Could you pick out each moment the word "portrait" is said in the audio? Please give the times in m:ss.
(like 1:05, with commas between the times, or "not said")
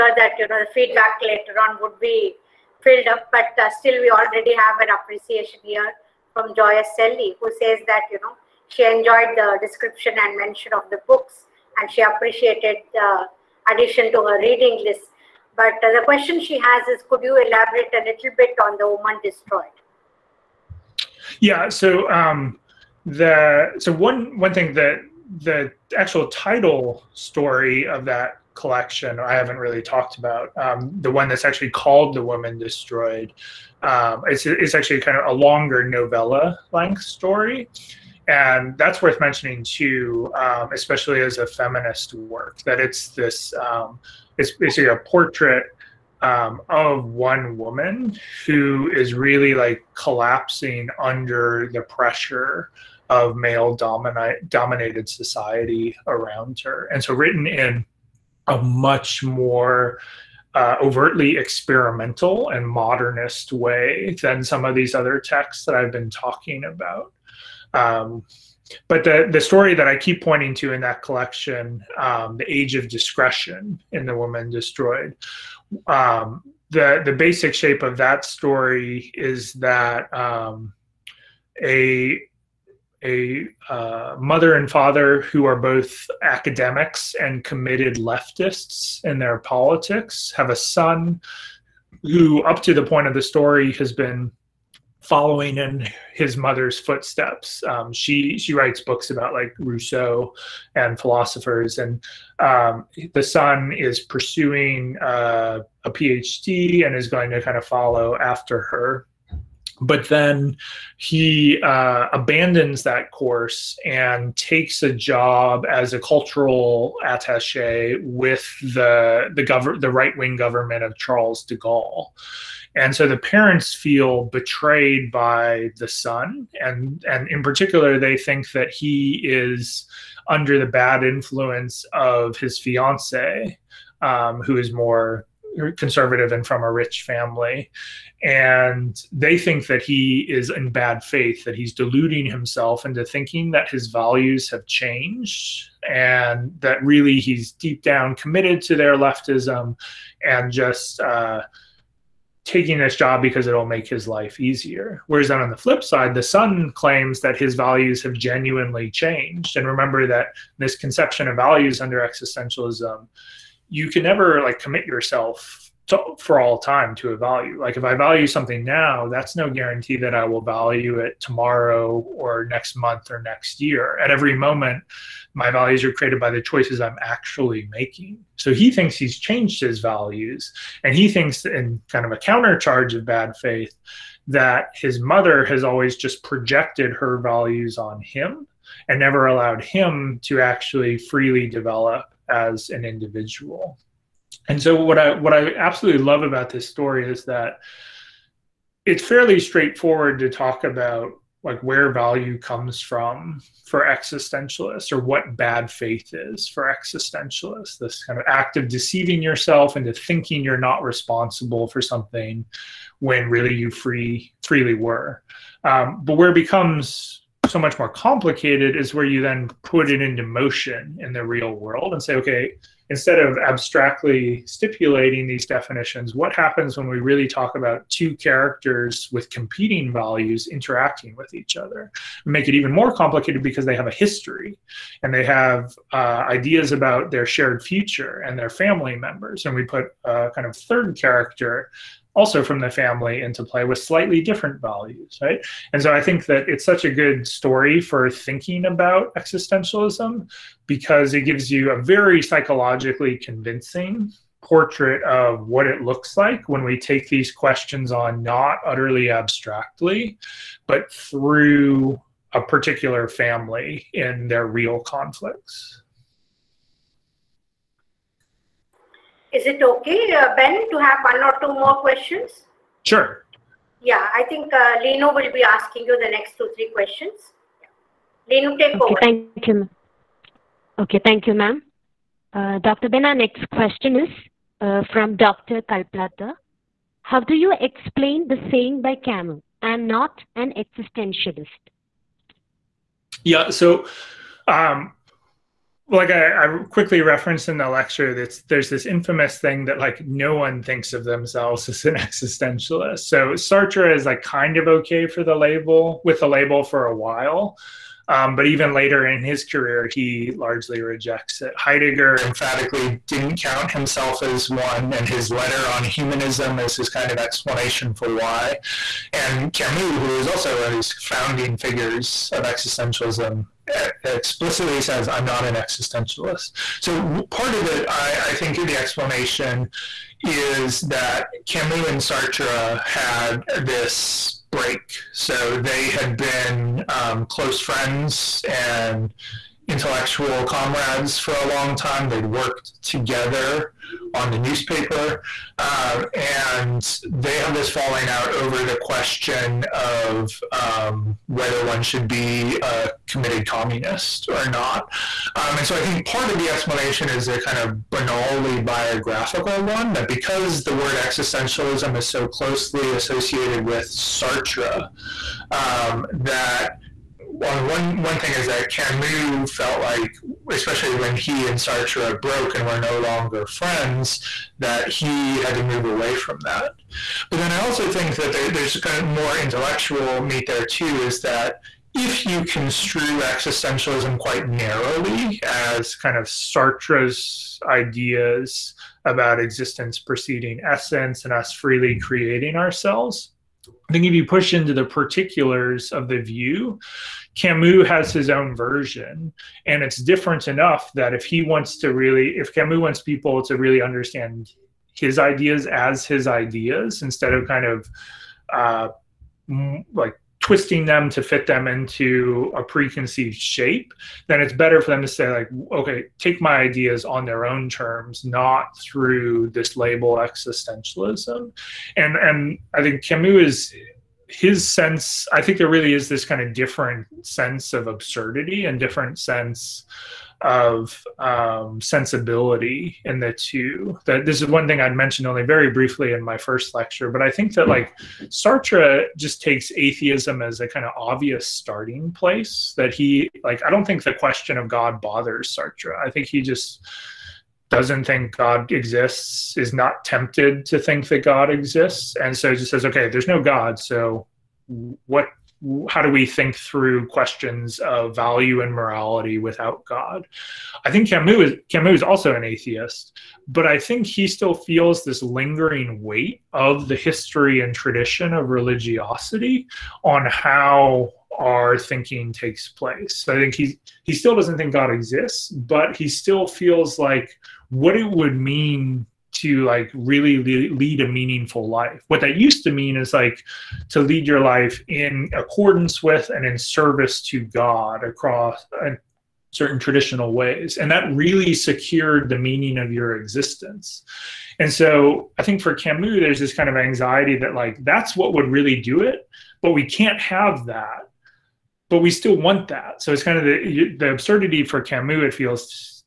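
0:44, 4:14.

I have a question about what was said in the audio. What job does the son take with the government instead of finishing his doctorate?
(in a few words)
cultural attaché.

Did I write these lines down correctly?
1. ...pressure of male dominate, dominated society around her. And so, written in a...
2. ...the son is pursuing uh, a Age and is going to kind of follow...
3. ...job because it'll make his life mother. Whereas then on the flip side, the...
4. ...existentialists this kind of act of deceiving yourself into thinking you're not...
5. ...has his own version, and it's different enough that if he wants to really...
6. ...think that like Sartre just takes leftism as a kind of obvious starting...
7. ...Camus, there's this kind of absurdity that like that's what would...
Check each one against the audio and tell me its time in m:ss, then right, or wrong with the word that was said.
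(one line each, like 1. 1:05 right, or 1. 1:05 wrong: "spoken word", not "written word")
1. 0:51 right
2. 1:43 wrong: "PhD", not "Age"
3. 2:32 wrong: "easier", not "mother"
4. 3:26 right
5. 6:37 right
6. 7:17 wrong: "atheism", not "leftism"
7. 8:15 wrong: "anxiety", not "absurdity".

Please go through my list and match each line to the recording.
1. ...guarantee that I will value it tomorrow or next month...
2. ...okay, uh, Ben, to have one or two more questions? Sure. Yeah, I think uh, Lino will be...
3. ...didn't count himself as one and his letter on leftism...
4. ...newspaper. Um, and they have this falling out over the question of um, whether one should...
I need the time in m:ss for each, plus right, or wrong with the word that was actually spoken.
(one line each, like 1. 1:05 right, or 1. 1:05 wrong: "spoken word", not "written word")
1. 2:49 right
2. 4:29 right
3. 5:13 wrong: "humanism", not "leftism"
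4. 5:44 right.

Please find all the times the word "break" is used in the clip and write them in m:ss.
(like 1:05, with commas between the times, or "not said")
5:34.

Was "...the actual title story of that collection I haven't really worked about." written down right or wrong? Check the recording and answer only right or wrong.
wrong.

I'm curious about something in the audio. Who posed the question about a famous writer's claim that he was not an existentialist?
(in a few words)
Dr. Kalplata.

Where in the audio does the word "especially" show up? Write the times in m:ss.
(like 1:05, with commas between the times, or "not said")
0:40, 6:10.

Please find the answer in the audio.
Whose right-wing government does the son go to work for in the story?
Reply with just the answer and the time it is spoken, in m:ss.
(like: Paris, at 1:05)
Charles de Gaulle, at 2:00.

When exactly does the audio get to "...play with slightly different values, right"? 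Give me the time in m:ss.
4:03.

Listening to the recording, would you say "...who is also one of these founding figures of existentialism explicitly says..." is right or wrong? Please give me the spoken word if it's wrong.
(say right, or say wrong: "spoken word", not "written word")
right.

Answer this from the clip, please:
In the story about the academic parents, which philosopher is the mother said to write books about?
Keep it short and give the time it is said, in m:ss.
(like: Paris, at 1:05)
Rousseau, at 1:39.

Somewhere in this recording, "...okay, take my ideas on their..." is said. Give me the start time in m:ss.
6:55.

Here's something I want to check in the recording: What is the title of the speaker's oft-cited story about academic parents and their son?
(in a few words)
The Age of Discretion.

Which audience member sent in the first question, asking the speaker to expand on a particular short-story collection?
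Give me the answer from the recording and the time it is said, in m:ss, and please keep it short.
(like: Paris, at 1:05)
Joya Selly, at 0:06.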